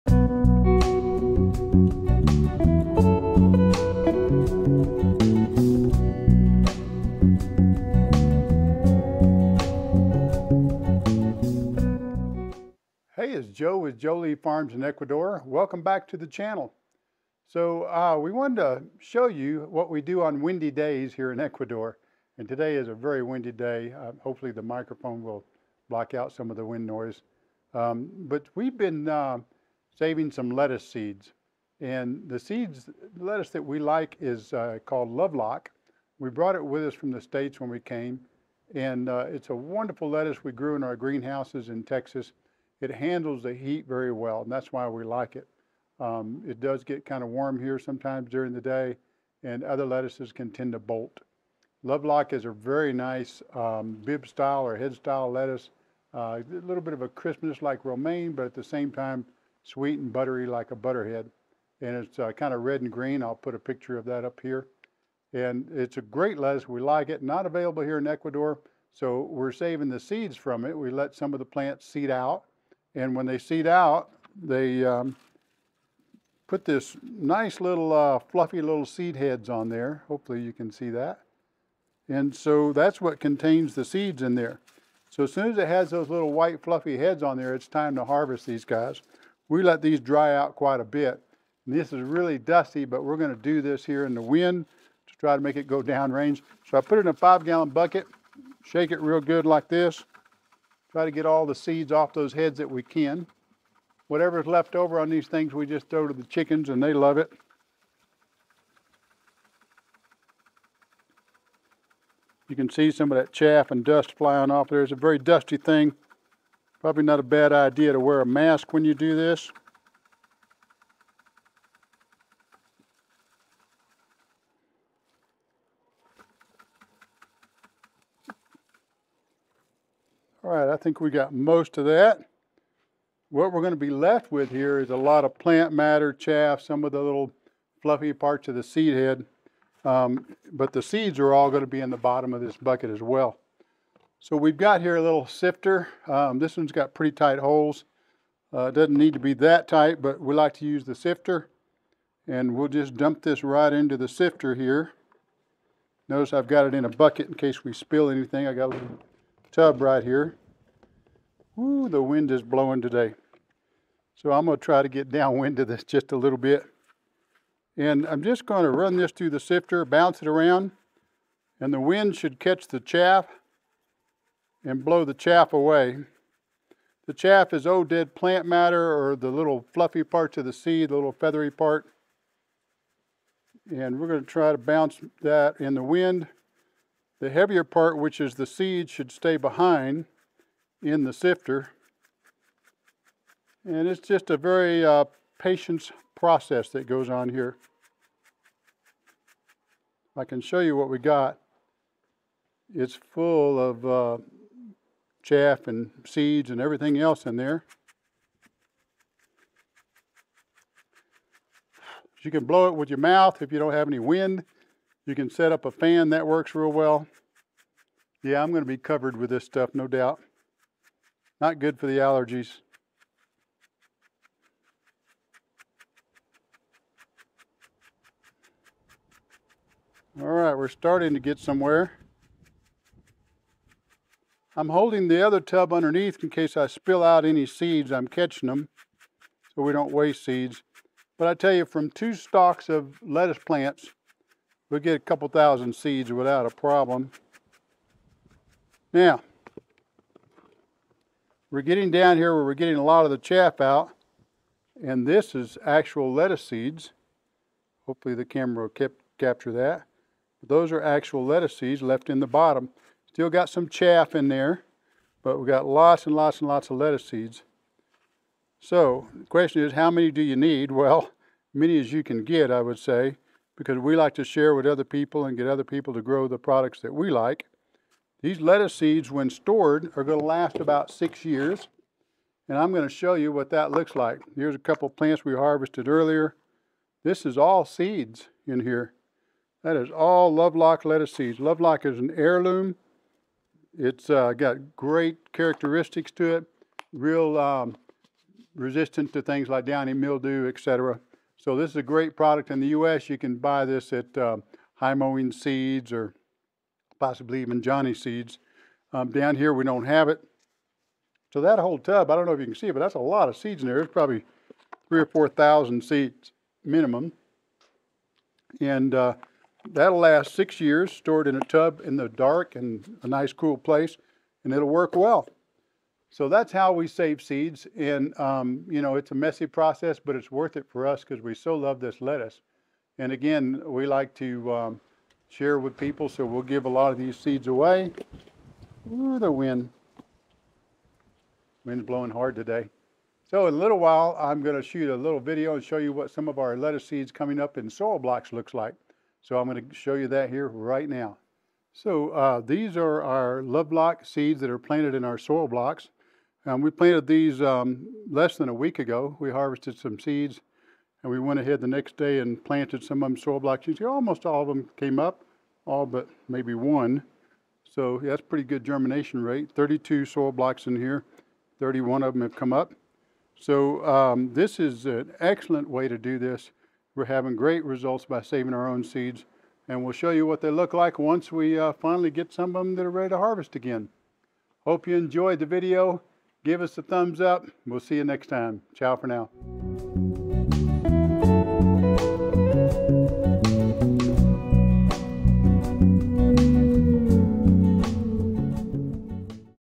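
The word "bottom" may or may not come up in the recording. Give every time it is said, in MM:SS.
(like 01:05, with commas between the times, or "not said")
02:21, 04:22.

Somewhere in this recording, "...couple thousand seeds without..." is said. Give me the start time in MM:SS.
04:04.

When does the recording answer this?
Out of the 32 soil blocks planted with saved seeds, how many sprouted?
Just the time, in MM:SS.
06:11.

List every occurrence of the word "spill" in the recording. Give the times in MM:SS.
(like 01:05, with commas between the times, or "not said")
02:37, 03:56.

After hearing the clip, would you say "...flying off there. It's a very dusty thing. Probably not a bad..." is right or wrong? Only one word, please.
right.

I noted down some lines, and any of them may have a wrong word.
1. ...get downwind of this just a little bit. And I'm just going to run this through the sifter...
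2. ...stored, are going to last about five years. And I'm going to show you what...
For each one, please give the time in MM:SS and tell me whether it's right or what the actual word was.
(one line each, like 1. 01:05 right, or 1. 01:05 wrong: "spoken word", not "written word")
1. 02:44 right
2. 04:39 wrong: "six", not "five".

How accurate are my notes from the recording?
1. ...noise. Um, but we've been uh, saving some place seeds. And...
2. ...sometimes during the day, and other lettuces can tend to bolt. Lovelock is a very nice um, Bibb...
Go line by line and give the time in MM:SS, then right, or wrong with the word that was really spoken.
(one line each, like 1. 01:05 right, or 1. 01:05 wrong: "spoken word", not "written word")
1. 00:26 wrong: "lettuce", not "place"
2. 00:47 right.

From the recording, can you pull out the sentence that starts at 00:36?
We brought it with us from the States when we came.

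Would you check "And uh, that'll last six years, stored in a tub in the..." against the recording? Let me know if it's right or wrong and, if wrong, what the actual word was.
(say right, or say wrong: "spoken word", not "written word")
right.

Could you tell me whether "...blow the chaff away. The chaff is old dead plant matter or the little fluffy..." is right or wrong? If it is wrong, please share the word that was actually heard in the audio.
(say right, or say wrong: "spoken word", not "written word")
right.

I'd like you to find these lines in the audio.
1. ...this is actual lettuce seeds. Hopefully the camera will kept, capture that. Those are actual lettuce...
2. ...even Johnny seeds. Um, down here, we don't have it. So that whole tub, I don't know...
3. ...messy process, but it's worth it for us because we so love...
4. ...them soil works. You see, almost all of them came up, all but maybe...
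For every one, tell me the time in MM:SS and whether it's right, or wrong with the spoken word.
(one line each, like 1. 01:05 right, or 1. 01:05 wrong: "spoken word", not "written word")
1. 04:15 right
2. 05:07 right
3. 05:29 right
4. 06:03 wrong: "blocks", not "works".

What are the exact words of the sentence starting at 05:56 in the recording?
Um, we planted these um, less than a week ago.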